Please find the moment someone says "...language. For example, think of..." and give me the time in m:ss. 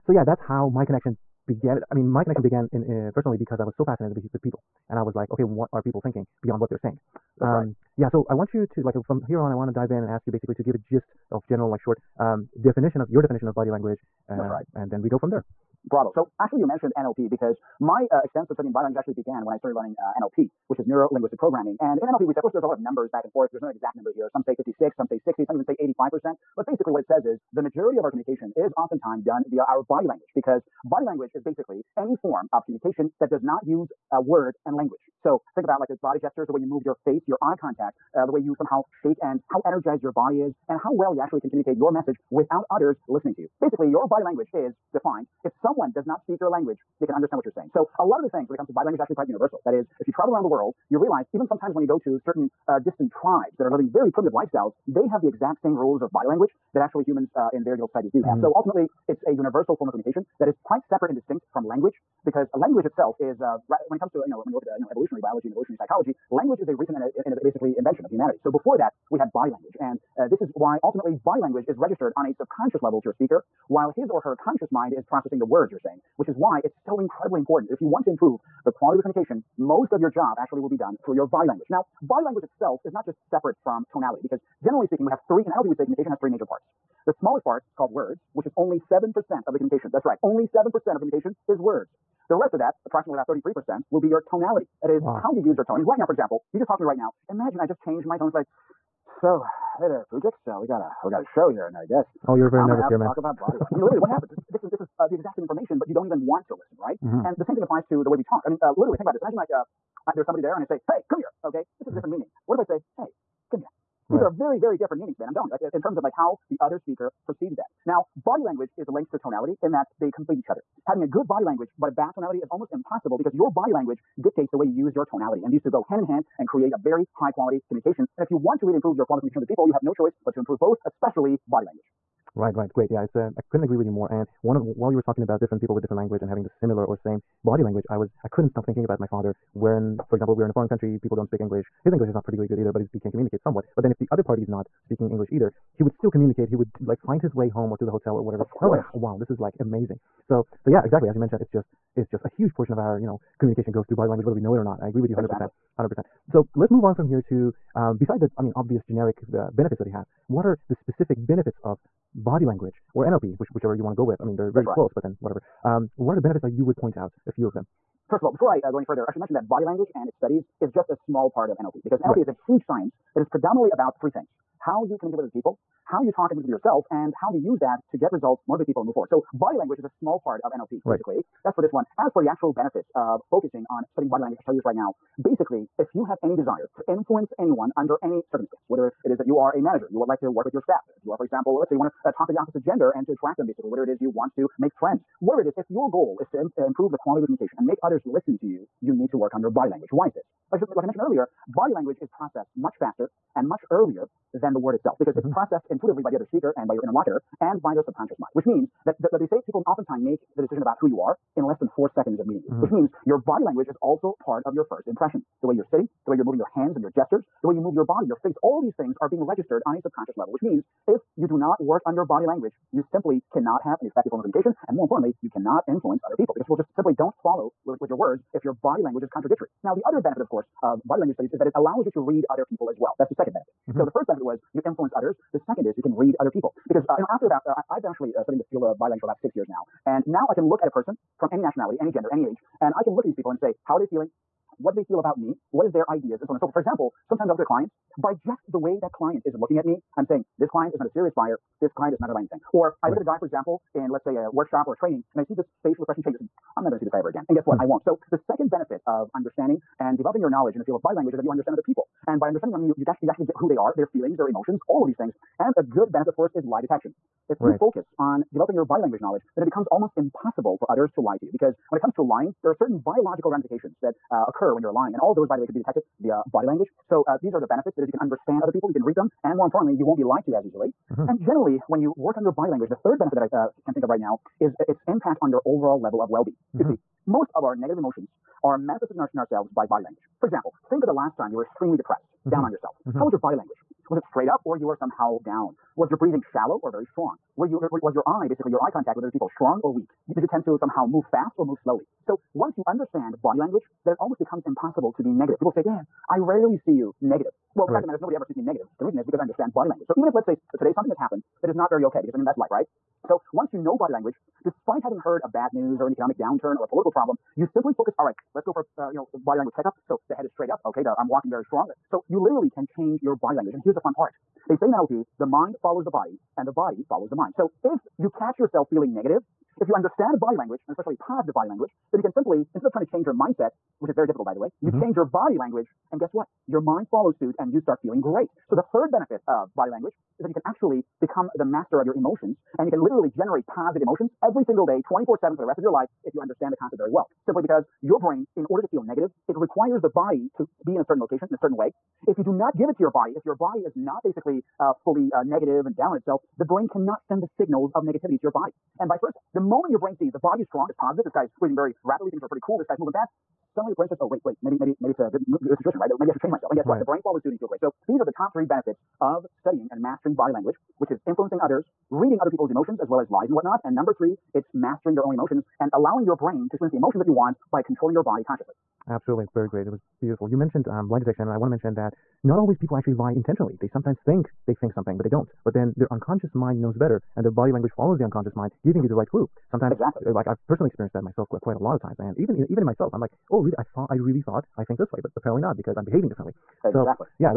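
4:49.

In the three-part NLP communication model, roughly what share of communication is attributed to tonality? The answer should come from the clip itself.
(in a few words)
33%.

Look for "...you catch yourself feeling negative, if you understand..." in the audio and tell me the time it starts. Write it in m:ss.
5:27.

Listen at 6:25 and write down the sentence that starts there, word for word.
But then their unconscious mind knows better and their body language follows the unconscious mind, giving you the right clue.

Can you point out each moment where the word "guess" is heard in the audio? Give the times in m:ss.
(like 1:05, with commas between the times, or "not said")
1:41, 4:17, 5:35, 6:06.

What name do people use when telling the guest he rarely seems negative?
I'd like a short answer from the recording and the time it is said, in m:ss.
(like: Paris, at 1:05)
Dan, at 5:05.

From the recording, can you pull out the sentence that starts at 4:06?
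For example, sometimes I look at a client by just the way that client is looking at me.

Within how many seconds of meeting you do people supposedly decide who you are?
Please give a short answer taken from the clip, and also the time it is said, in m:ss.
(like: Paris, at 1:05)
four seconds, at 3:31.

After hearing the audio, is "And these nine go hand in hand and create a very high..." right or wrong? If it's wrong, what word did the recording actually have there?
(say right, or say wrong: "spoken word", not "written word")
wrong: "two", not "nine".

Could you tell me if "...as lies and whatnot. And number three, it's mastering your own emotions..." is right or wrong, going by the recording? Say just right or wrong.
right.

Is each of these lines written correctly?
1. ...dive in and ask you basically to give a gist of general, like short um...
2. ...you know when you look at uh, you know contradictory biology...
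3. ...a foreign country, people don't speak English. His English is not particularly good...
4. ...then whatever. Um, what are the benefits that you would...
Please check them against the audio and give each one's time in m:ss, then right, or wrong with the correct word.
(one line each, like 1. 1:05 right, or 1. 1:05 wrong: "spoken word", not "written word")
1. 0:09 right
2. 1:04 wrong: "evolutionary", not "contradictory"
3. 2:20 right
4. 2:45 right.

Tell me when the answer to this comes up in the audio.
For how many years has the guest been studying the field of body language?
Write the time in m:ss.
3:59.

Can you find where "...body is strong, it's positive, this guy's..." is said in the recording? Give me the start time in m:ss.
6:00.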